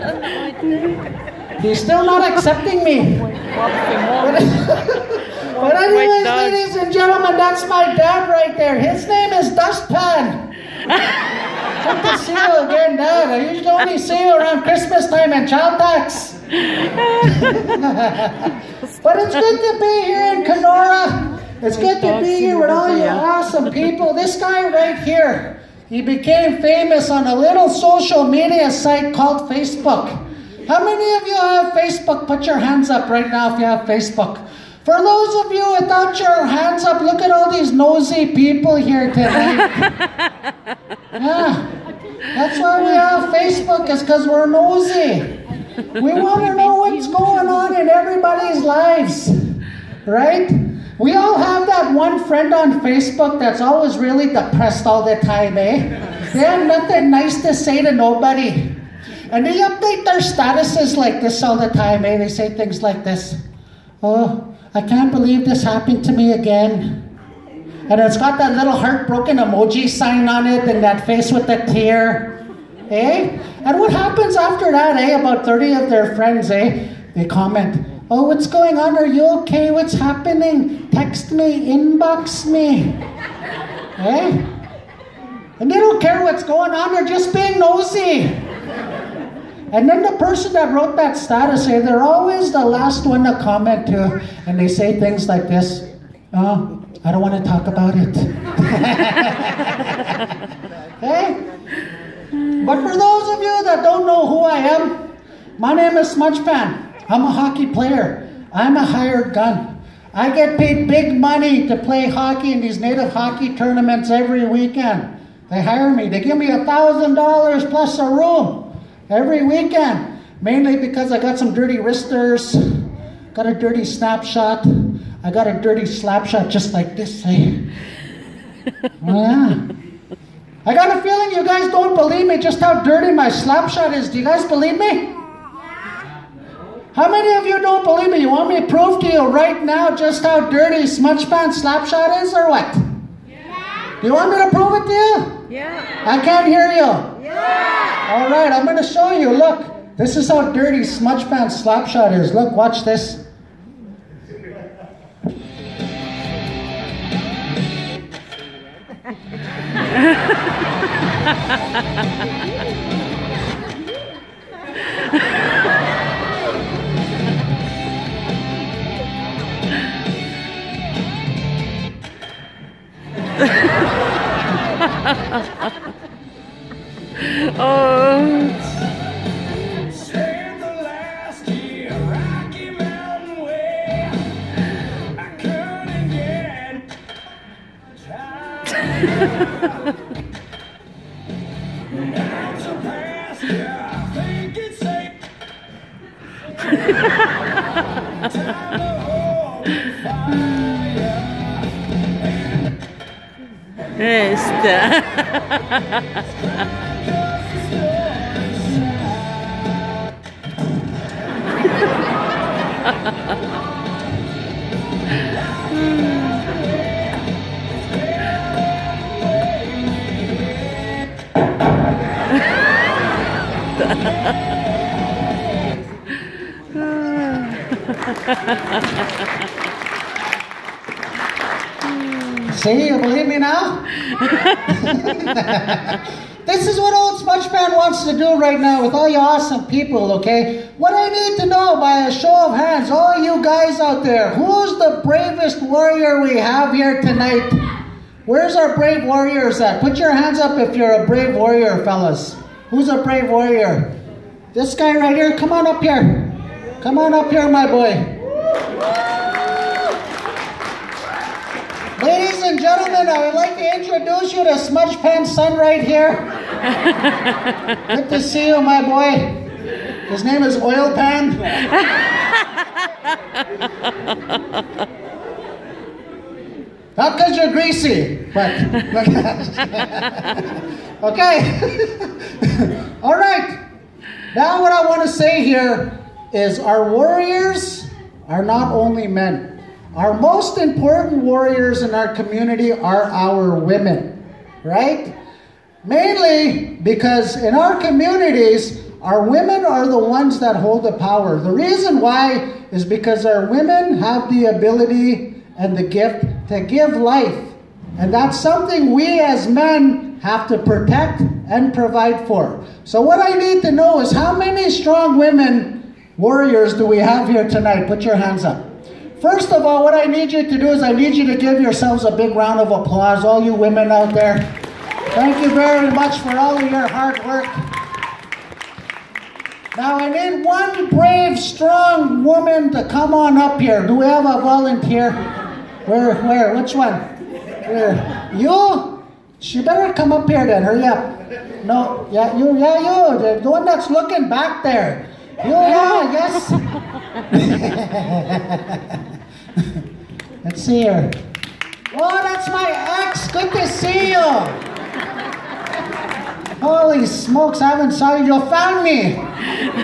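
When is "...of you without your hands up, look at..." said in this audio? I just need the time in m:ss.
0:35.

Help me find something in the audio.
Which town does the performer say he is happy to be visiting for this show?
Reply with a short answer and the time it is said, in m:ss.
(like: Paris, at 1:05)
Kenora, at 0:20.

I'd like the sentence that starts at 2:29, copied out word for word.
Look, this is how dirty smudge Smudgepan Slapshot is.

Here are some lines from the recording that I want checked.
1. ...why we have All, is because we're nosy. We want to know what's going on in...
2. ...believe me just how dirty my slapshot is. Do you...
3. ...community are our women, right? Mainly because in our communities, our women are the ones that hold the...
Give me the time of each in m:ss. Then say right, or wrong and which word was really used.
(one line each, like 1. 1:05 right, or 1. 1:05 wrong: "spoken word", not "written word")
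1. 0:42 wrong: "Facebook", not "All"
2. 2:11 right
3. 4:52 right.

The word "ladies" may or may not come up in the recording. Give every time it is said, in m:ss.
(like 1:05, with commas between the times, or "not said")
0:06, 4:22.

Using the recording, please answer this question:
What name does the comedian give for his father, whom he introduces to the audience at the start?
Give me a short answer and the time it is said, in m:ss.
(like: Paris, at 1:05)
Dustpan, at 0:09.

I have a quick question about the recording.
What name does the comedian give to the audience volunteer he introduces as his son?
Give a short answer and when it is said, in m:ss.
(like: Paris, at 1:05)
Oil Pan, at 4:30.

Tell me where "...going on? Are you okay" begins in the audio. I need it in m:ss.
1:18.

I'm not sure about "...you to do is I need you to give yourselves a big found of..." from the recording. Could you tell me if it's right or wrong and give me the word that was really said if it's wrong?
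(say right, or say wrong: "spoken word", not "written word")
wrong: "round", not "found".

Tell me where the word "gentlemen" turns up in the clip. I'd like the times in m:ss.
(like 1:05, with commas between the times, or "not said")
0:06, 4:22.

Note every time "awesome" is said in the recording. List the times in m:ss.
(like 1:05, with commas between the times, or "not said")
0:23, 3:59.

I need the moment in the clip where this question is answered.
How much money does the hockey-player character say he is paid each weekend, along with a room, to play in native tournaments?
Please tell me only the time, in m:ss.
1:56.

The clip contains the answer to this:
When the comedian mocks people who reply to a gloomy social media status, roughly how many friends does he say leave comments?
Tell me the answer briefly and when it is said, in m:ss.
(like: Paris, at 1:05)
30, at 1:15.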